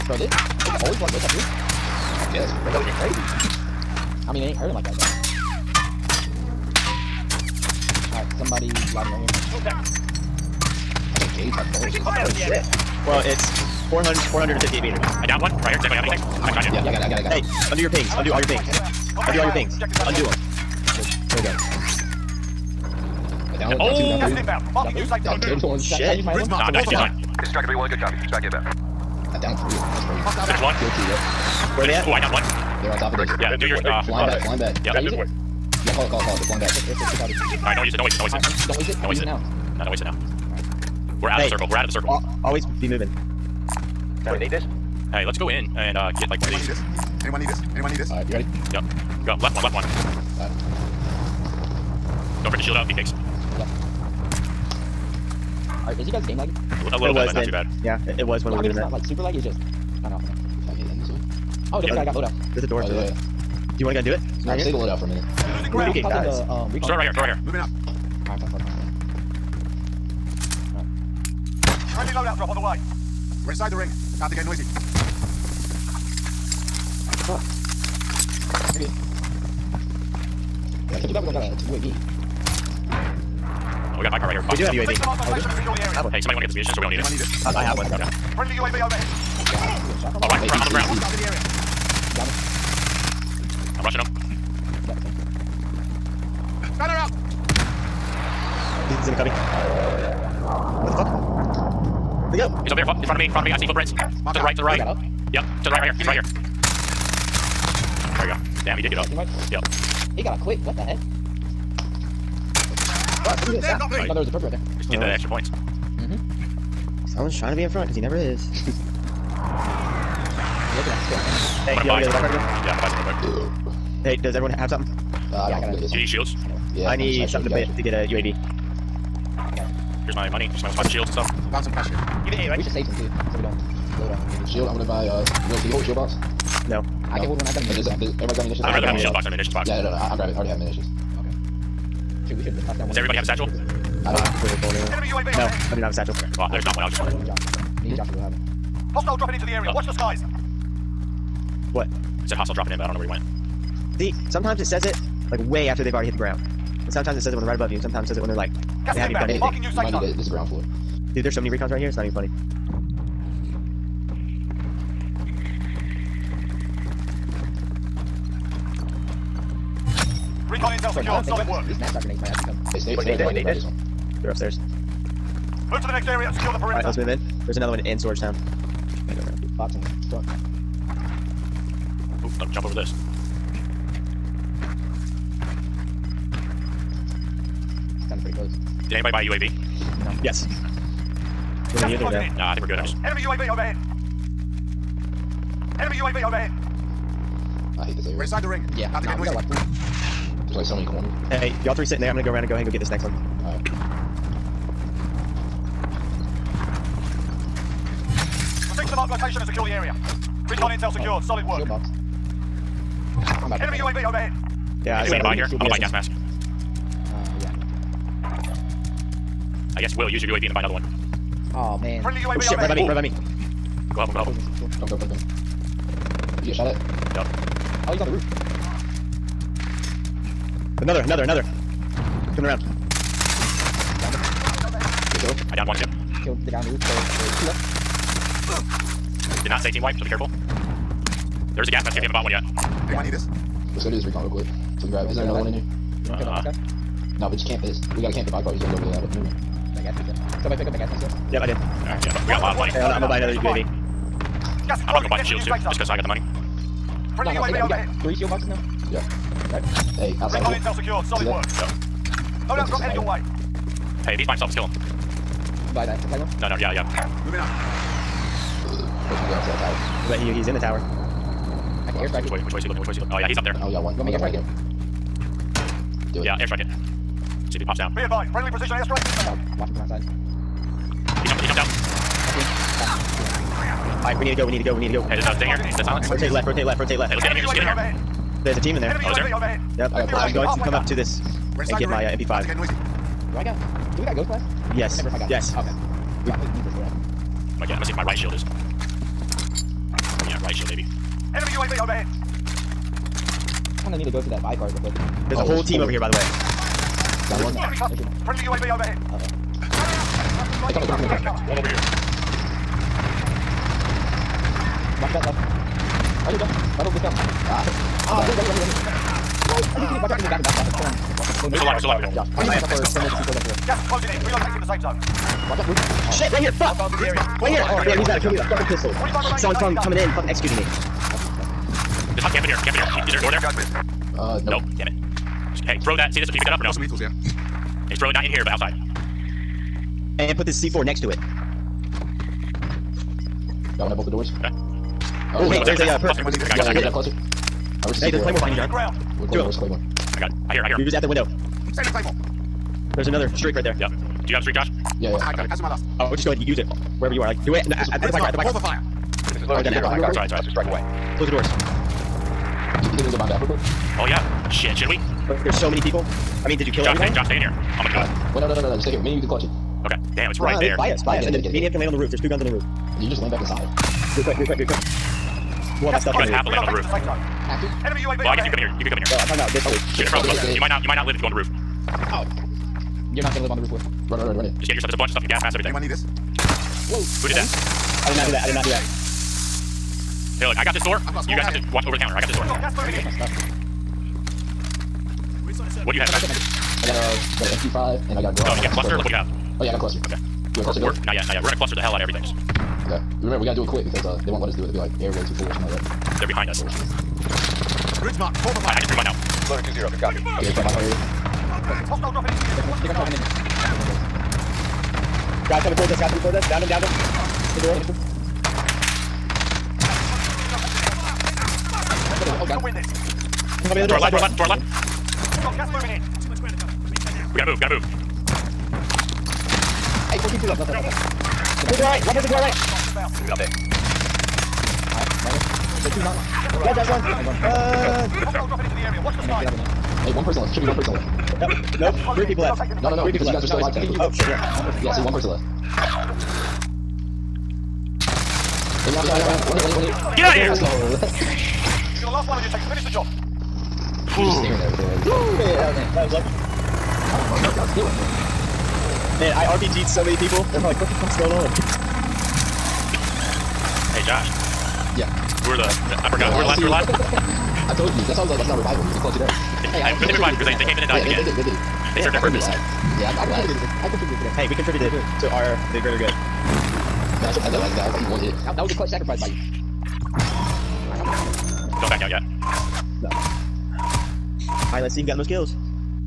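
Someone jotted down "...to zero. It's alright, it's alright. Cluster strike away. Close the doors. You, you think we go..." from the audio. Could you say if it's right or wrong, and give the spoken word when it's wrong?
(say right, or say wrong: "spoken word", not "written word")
right.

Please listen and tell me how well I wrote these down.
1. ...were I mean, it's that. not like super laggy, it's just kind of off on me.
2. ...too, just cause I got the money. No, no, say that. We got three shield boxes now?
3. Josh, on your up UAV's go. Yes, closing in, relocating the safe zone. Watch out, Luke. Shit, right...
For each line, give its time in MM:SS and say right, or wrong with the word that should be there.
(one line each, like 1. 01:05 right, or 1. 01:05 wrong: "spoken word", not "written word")
1. 00:58 right
2. 04:15 right
3. 05:22 wrong: "Let", not "UAV".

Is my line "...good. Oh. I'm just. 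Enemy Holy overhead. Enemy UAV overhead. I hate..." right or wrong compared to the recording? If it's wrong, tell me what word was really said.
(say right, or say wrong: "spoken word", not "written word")
wrong: "UAV", not "Holy".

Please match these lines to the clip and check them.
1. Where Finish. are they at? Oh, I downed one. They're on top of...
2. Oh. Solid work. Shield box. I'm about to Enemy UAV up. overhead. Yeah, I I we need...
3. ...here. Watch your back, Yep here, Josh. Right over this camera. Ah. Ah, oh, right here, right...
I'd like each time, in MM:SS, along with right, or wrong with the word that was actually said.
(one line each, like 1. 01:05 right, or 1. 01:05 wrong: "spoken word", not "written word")
1. 00:31 right
2. 03:31 right
3. 05:11 wrong: "Right", not "Yep".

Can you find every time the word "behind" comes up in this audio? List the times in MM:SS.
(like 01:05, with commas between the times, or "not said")
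01:08, 05:48, 06:46.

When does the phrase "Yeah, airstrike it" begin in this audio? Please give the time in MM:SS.
04:36.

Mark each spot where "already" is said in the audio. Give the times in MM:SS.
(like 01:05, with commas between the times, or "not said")
02:20, 02:35.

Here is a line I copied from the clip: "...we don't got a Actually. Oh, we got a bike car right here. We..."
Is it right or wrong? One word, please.
wrong.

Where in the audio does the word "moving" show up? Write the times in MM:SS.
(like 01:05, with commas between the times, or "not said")
00:42, 01:07, 04:27, 07:05.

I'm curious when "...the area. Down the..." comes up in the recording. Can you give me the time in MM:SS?
01:31.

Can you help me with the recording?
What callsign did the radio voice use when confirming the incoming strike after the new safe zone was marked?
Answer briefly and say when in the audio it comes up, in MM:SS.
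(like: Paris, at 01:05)
Striker 3-1, at 00:27.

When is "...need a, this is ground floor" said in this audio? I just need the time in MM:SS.
02:39.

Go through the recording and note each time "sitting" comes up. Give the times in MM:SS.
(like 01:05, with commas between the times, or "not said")
03:21.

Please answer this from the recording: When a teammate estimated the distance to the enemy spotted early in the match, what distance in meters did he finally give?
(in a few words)
458 meters.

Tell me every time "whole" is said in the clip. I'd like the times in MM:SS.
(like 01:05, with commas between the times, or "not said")
05:05, 07:10.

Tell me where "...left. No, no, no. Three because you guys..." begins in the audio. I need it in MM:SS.
07:22.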